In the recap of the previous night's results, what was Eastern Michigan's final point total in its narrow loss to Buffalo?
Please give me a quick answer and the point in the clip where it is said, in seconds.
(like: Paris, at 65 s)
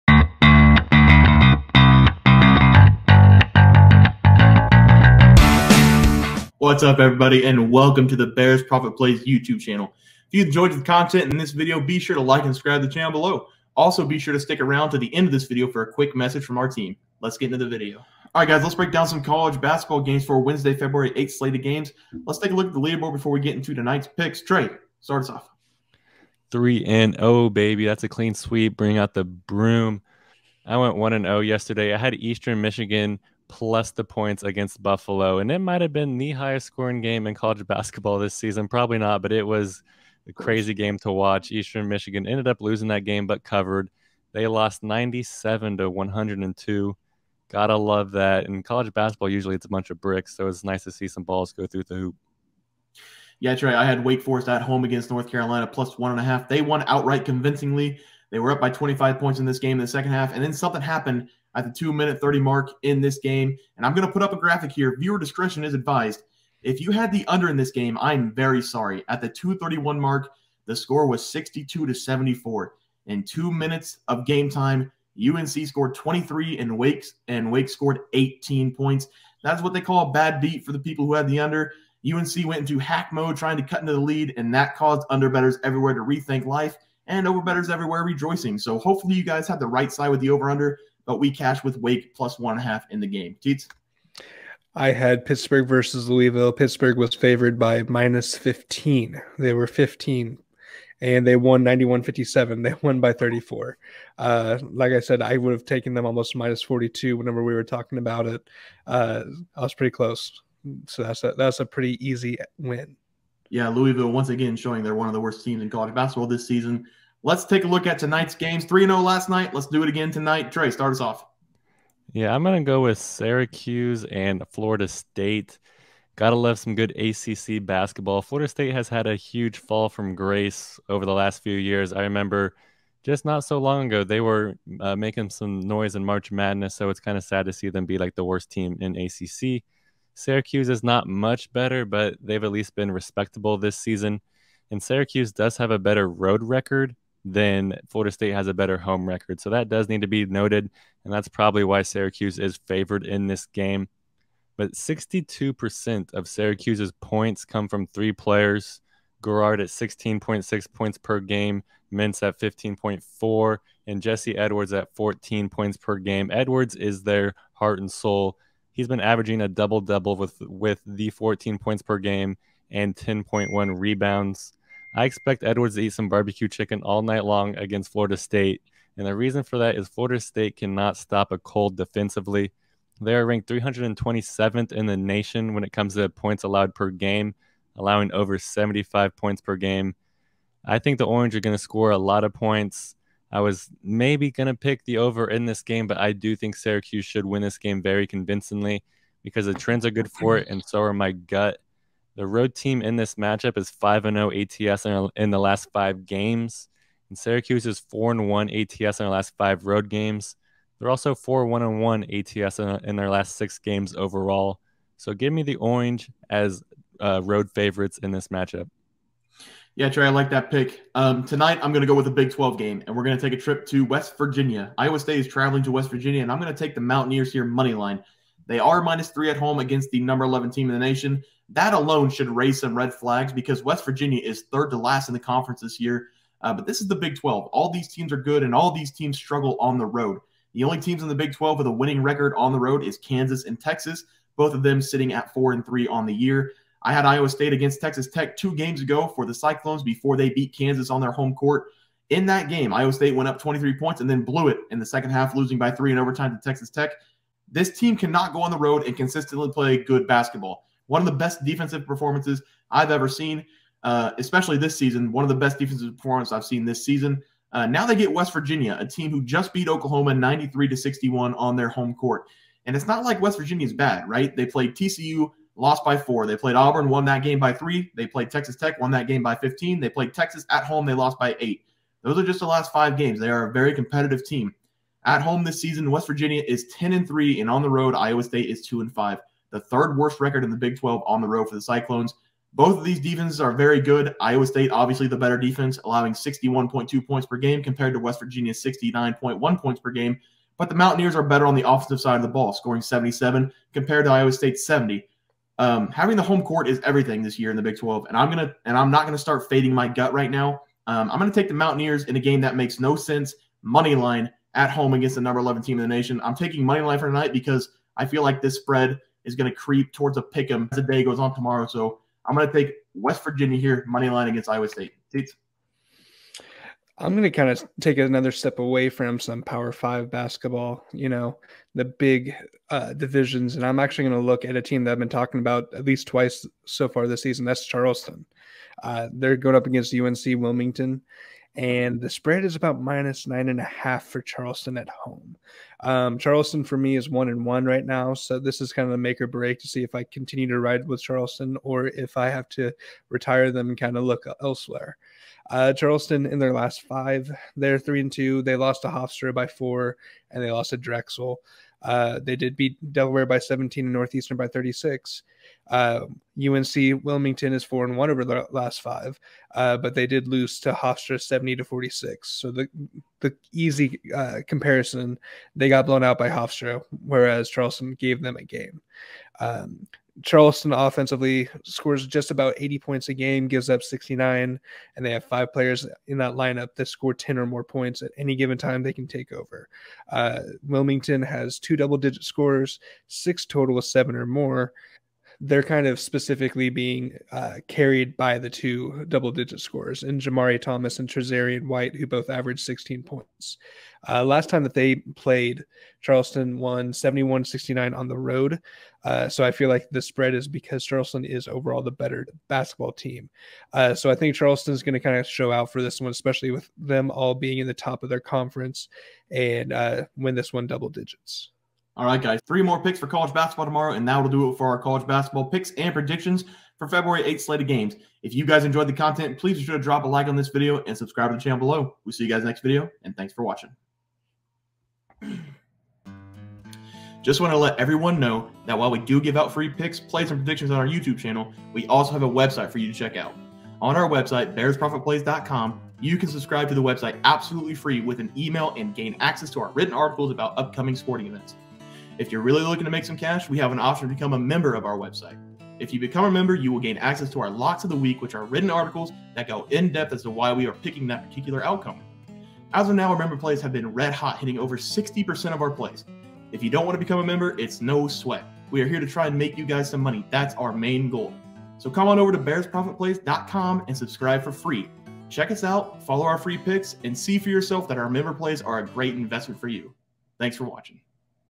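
97, at 44 s.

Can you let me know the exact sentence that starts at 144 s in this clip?
And Syracuse does have a better road record than Florida State has a better home record.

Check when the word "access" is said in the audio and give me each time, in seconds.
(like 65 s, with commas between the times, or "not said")
449 s, 456 s.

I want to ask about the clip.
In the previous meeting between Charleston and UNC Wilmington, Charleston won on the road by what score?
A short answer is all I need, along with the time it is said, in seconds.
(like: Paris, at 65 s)
71-69, at 406 s.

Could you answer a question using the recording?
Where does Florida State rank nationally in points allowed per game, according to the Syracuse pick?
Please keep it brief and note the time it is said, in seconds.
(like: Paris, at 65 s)
327th, at 183 s.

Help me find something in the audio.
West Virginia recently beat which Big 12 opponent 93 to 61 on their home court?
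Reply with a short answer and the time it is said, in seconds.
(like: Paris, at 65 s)
Oklahoma, at 269 s.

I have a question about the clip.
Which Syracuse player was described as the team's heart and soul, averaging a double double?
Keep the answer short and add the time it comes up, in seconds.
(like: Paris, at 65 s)
Jesse Edwards, at 164 s.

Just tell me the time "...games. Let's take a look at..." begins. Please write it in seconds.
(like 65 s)
21 s.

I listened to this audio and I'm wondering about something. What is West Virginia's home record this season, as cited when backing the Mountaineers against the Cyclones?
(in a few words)
10 and 3.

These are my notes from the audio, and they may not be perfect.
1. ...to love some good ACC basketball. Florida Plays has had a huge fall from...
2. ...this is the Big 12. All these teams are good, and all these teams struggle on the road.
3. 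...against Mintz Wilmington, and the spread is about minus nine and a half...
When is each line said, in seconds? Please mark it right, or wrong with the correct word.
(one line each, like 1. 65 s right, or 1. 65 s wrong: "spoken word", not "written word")
1. 126 s wrong: "State", not "Plays"
2. 236 s right
3. 339 s wrong: "UNC", not "Mintz".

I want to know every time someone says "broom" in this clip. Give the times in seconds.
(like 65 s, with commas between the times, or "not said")
29 s.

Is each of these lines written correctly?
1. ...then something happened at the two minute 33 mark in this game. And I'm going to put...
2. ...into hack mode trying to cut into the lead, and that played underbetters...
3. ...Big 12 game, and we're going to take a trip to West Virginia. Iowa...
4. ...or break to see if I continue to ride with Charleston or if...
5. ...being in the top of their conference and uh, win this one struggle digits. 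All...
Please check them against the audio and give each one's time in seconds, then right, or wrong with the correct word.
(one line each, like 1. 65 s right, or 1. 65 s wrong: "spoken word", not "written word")
1. 60 s wrong: "30", not "33"
2. 82 s wrong: "caused", not "played"
3. 222 s right
4. 349 s right
5. 417 s wrong: "double", not "struggle".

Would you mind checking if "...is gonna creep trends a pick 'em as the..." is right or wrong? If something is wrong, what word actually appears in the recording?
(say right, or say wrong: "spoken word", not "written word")
wrong: "towards", not "trends".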